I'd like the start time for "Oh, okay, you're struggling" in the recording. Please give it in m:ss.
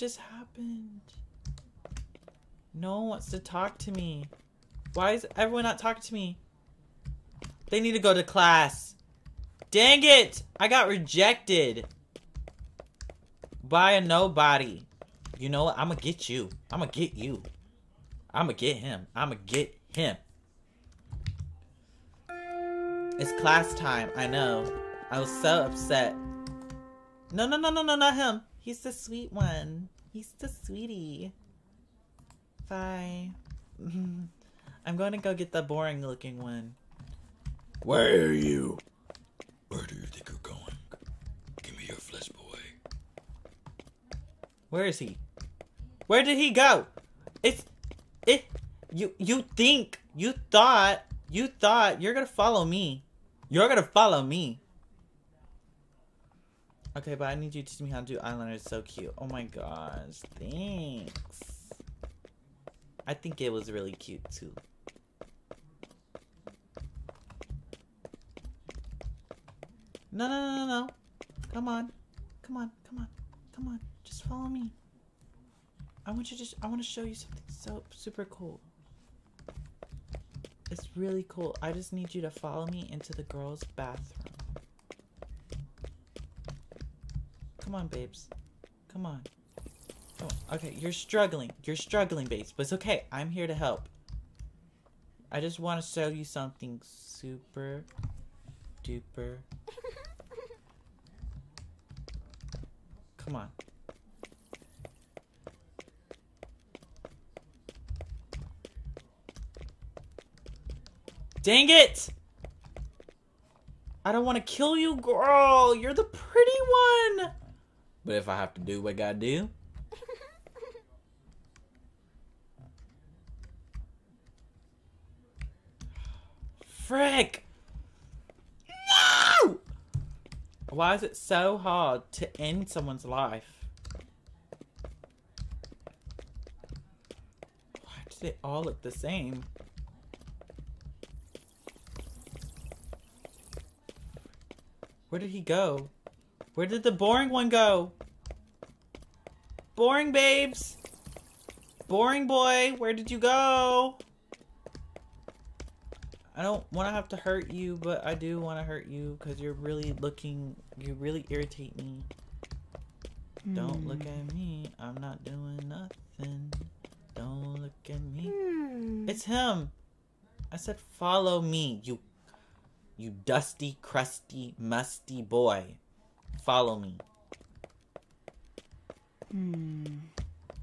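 1:30.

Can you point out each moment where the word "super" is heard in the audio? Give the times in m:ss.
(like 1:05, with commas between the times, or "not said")
1:17, 1:36.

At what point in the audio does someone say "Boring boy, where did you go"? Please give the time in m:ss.
2:31.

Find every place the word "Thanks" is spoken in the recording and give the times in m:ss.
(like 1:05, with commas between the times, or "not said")
1:00.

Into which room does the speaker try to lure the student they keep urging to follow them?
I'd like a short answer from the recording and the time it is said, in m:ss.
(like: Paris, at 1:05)
girls' bathroom, at 1:23.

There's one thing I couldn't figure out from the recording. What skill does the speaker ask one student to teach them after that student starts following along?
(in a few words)
eyeliner.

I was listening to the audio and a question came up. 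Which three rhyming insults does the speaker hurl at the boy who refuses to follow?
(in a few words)
dusty, crusty, musty.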